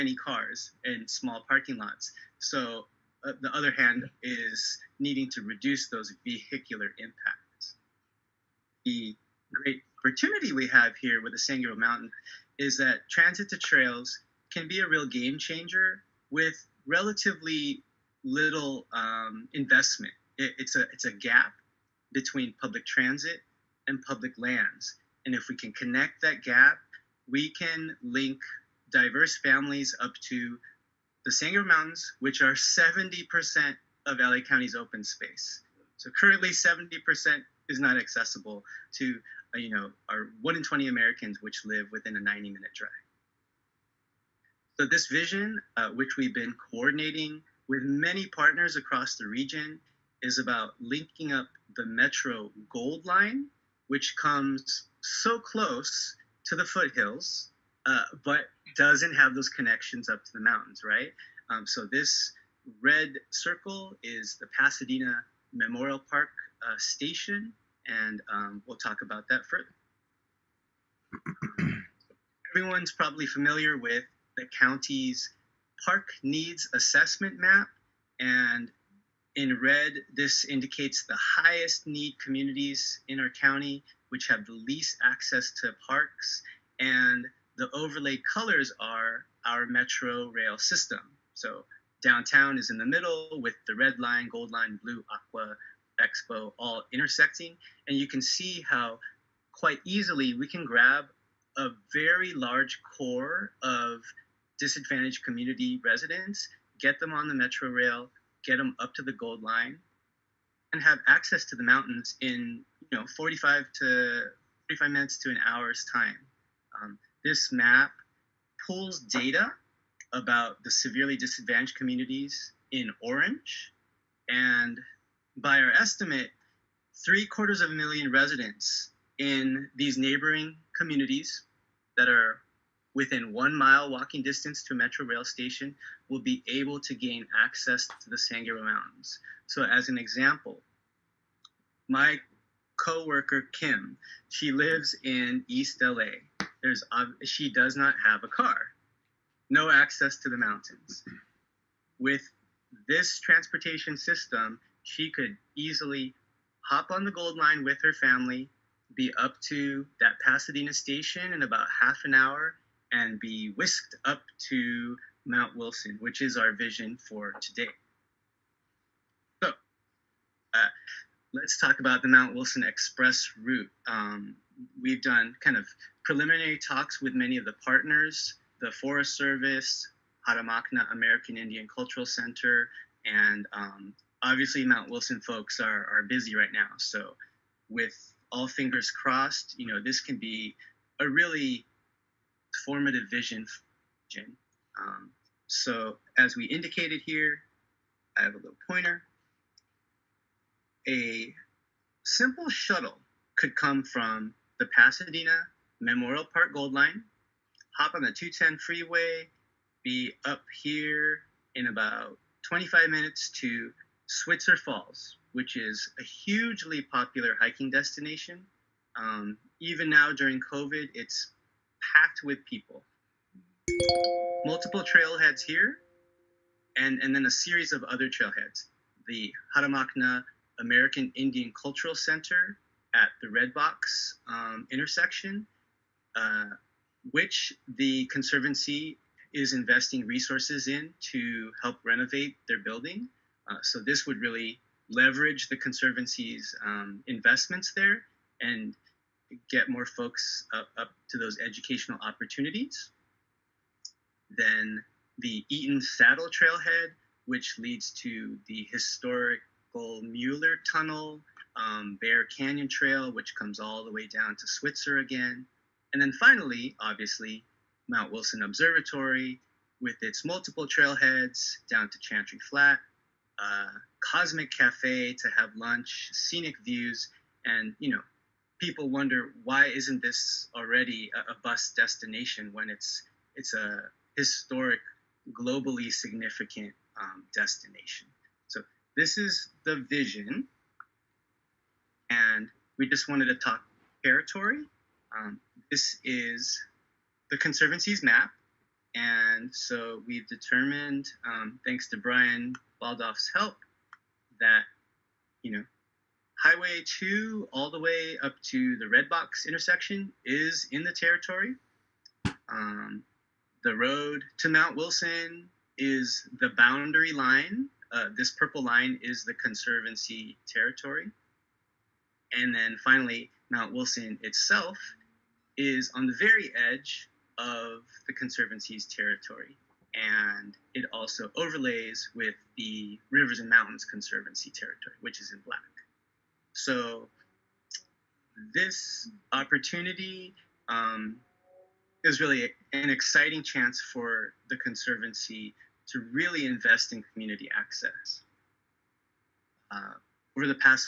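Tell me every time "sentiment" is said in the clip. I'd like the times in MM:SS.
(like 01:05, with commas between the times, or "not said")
not said.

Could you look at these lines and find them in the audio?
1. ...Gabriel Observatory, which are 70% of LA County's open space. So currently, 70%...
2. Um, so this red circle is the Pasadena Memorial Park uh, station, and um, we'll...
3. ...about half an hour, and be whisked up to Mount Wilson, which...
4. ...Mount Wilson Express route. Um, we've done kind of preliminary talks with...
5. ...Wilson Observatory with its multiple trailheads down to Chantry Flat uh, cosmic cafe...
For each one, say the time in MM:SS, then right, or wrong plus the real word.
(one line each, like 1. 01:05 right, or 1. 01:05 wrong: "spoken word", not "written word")
1. 00:31 wrong: "Mountains", not "Observatory"
2. 01:01 right
3. 02:41 right
4. 02:52 right
5. 04:28 right.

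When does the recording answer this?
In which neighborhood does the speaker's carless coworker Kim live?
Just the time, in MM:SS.
02:25.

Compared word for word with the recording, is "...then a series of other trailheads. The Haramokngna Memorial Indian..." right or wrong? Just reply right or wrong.
wrong.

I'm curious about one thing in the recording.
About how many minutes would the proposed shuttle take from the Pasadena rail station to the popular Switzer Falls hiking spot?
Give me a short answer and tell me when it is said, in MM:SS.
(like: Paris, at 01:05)
25 minutes, at 03:32.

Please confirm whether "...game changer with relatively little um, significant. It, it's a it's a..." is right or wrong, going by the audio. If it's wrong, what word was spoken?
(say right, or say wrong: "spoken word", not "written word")
wrong: "investment", not "significant".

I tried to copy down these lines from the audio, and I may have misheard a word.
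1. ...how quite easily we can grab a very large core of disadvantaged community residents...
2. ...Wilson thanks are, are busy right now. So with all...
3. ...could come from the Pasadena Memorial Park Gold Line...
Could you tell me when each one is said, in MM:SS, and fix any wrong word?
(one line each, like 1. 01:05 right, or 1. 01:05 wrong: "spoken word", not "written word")
1. 01:38 right
2. 03:04 wrong: "folks", not "thanks"
3. 03:23 right.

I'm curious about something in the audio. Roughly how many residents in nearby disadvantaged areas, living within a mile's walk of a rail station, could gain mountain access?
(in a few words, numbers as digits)
three quarters of a million.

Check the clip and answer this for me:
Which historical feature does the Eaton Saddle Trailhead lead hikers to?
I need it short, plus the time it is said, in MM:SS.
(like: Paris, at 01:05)
Mueller Tunnel, at 04:20.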